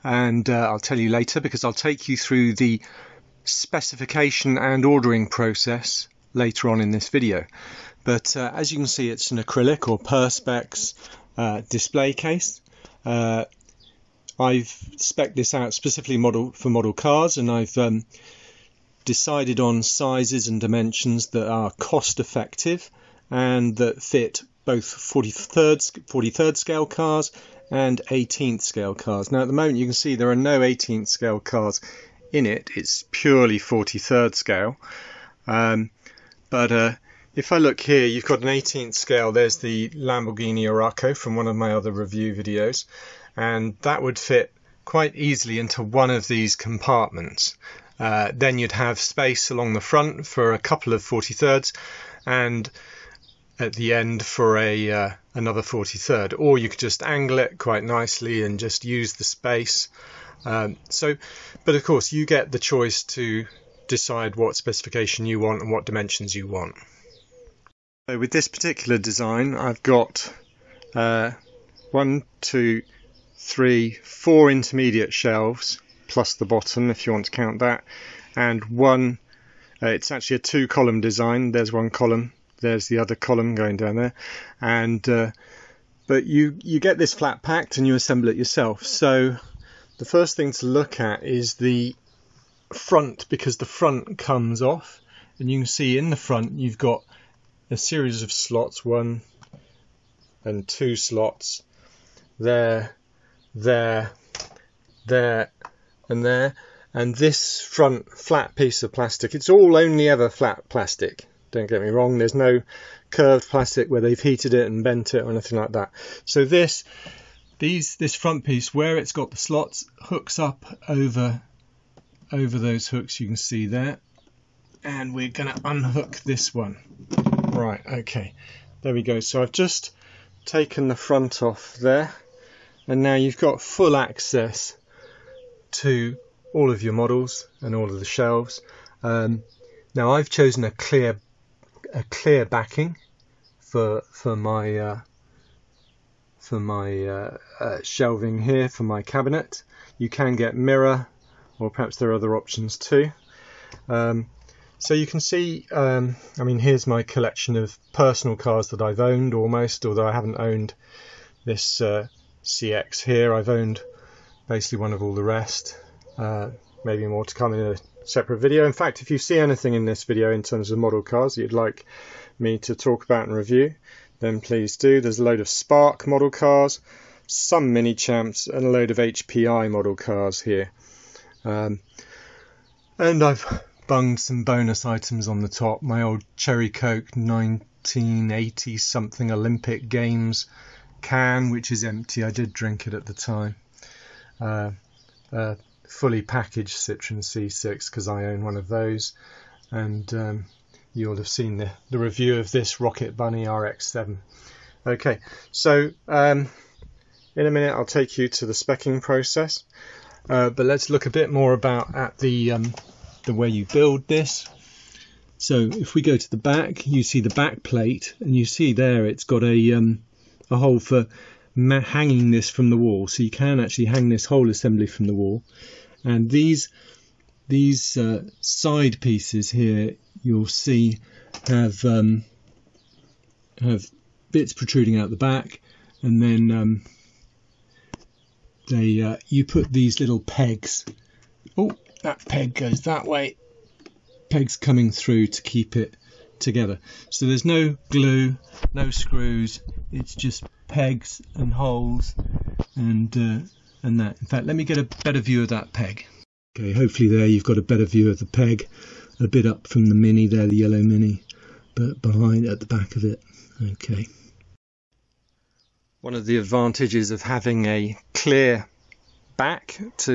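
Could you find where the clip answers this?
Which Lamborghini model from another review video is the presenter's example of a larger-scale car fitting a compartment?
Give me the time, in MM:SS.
00:39.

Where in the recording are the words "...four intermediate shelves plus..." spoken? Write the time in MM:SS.
01:14.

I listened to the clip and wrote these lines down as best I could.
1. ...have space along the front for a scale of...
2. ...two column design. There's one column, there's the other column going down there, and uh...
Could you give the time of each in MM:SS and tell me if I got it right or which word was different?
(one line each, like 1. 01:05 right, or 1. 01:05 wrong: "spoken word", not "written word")
1. 00:48 wrong: "couple", not "scale"
2. 01:20 right.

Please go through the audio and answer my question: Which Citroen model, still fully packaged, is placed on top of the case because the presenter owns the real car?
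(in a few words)
C6.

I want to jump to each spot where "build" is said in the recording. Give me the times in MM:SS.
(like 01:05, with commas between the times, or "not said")
03:33.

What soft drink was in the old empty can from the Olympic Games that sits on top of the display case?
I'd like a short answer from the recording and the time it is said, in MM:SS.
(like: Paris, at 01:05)
Cherry Coke, at 03:06.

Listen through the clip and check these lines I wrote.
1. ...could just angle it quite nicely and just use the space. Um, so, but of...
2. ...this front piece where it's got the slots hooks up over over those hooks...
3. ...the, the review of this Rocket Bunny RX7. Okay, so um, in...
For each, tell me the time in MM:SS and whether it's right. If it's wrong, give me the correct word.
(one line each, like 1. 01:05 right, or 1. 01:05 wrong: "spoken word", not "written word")
1. 00:56 right
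2. 01:57 right
3. 03:21 right.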